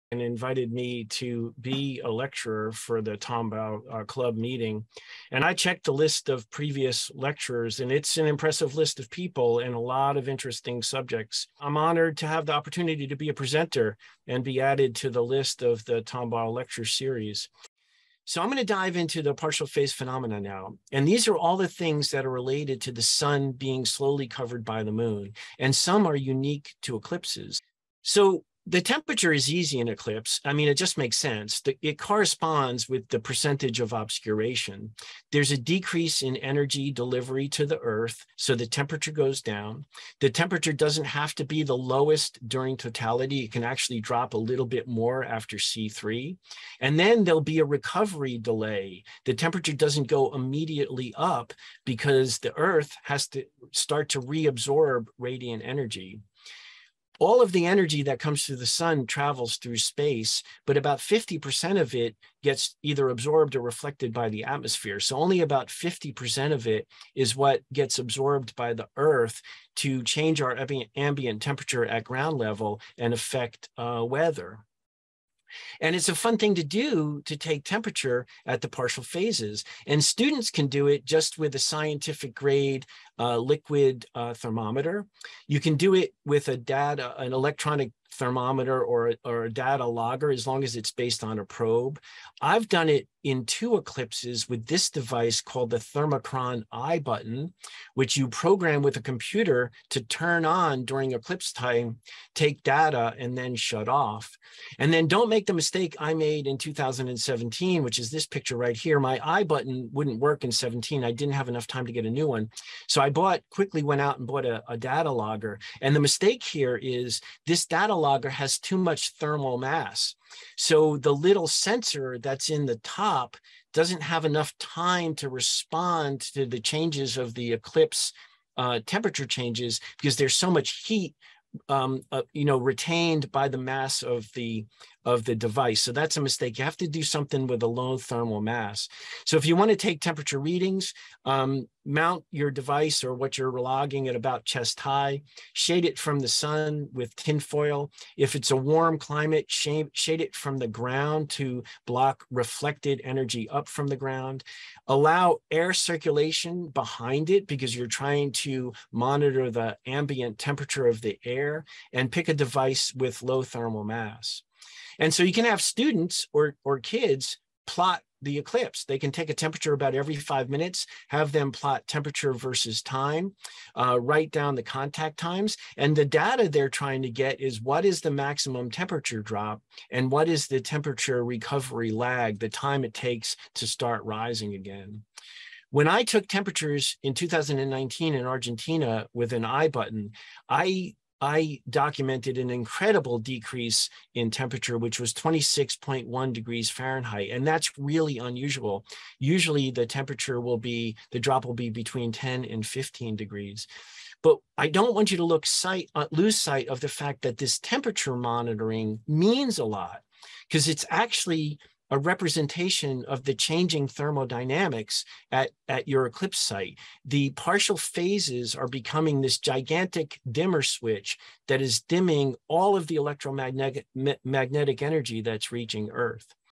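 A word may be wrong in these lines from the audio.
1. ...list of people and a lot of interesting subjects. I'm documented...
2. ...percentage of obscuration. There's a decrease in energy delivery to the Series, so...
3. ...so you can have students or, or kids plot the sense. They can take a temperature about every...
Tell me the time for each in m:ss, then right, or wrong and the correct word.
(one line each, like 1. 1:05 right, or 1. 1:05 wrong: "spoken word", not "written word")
1. 0:08 wrong: "honored", not "documented"
2. 0:33 wrong: "Earth", not "Series"
3. 2:45 wrong: "eclipse", not "sense".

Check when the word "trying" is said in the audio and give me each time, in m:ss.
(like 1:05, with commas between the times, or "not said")
2:37, 2:56.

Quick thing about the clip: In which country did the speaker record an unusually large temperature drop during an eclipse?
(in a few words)
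Argentina.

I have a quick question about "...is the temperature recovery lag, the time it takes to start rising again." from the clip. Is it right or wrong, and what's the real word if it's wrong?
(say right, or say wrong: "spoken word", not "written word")
right.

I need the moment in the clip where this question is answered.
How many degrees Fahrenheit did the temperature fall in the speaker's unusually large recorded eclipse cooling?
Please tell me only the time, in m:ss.
3:15.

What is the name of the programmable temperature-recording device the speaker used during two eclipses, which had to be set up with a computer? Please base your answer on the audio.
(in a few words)
Thermochron iButton.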